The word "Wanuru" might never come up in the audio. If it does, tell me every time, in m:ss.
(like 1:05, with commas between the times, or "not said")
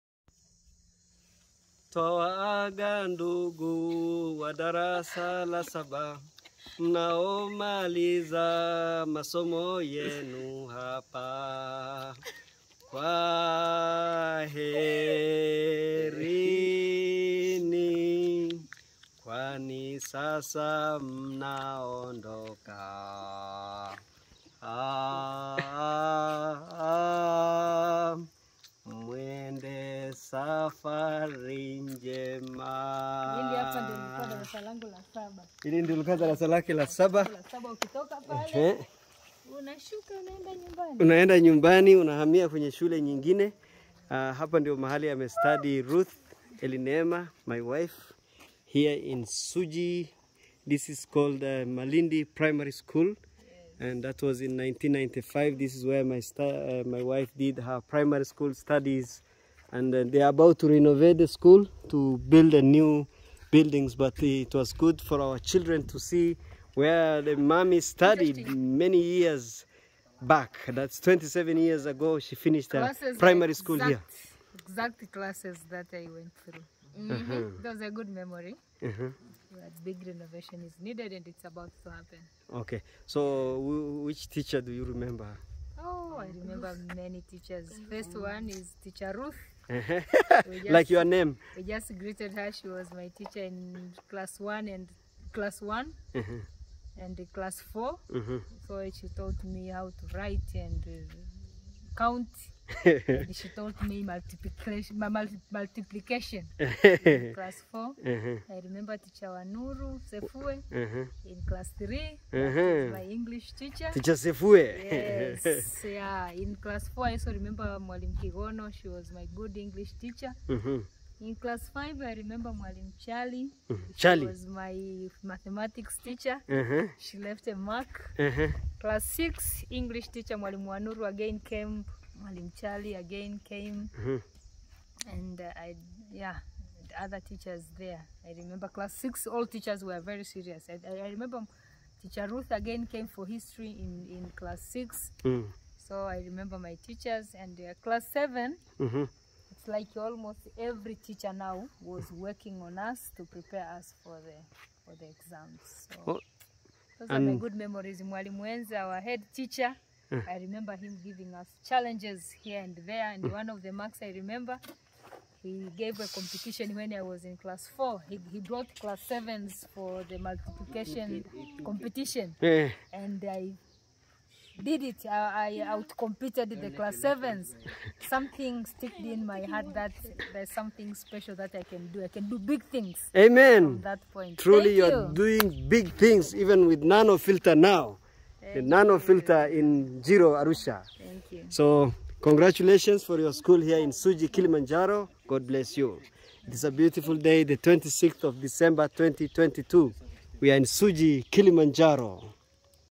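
1:49, 2:10.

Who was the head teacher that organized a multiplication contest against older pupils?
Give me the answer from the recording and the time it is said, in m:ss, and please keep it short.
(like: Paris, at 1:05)
Mwalimu Enza, at 2:38.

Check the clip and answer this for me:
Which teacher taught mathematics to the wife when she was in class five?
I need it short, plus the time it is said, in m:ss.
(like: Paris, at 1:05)
Mwalimu Chali, at 2:02.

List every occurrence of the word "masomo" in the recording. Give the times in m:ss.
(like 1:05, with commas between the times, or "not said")
0:09.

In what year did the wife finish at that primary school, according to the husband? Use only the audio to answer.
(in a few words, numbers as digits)
1995.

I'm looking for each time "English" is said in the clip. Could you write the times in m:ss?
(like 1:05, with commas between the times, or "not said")
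1:53, 1:59, 2:09.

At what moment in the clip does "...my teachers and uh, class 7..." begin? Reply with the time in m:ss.
2:26.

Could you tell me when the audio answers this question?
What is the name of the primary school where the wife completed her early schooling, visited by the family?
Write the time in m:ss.
0:51.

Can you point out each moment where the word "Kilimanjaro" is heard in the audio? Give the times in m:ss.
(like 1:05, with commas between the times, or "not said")
3:14, 3:21.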